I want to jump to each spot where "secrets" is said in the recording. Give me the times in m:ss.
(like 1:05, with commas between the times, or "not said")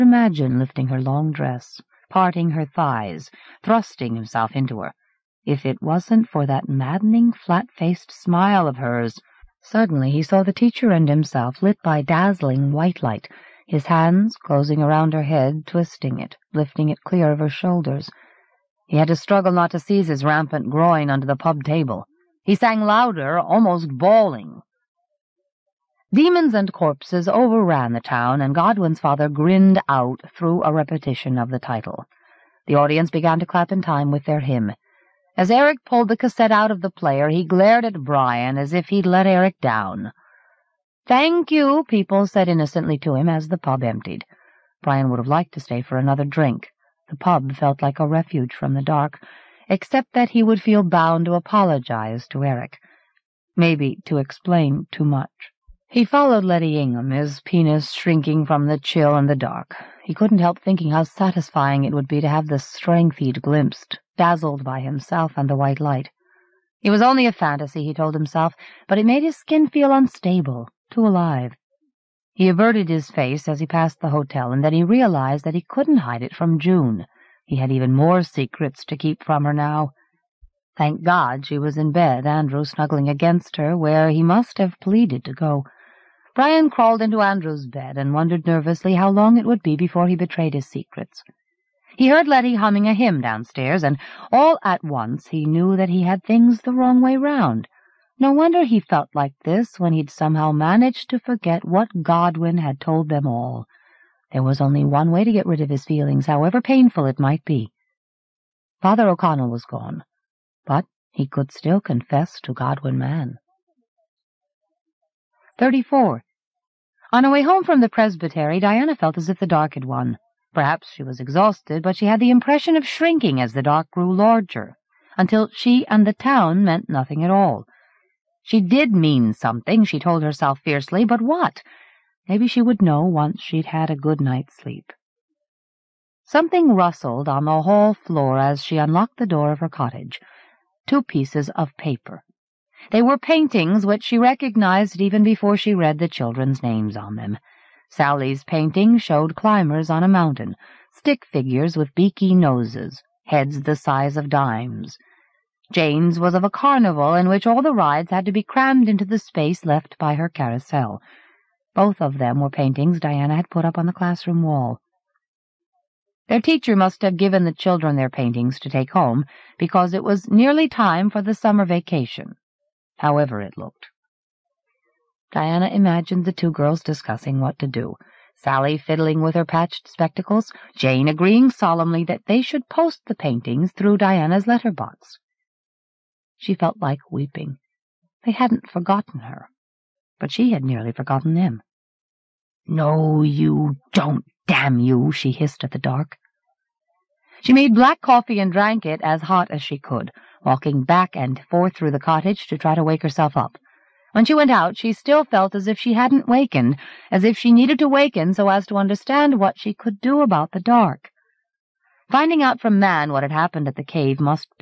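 1:18, 1:30.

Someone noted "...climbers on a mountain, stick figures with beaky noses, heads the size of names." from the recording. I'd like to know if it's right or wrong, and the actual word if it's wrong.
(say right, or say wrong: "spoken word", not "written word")
wrong: "dimes", not "names".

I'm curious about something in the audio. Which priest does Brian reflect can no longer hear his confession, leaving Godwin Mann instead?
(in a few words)
Father O'Connell.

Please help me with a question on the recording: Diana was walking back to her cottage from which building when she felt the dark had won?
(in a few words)
the presbytery.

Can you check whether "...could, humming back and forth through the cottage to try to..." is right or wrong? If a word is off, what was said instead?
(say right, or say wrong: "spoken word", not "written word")
wrong: "walking", not "humming".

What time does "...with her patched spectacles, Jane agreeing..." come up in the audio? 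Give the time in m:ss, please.
2:59.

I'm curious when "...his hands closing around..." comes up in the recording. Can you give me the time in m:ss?
0:13.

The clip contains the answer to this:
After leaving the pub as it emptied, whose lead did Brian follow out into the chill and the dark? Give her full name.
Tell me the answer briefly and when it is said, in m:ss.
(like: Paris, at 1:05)
Letty Ingham, at 0:56.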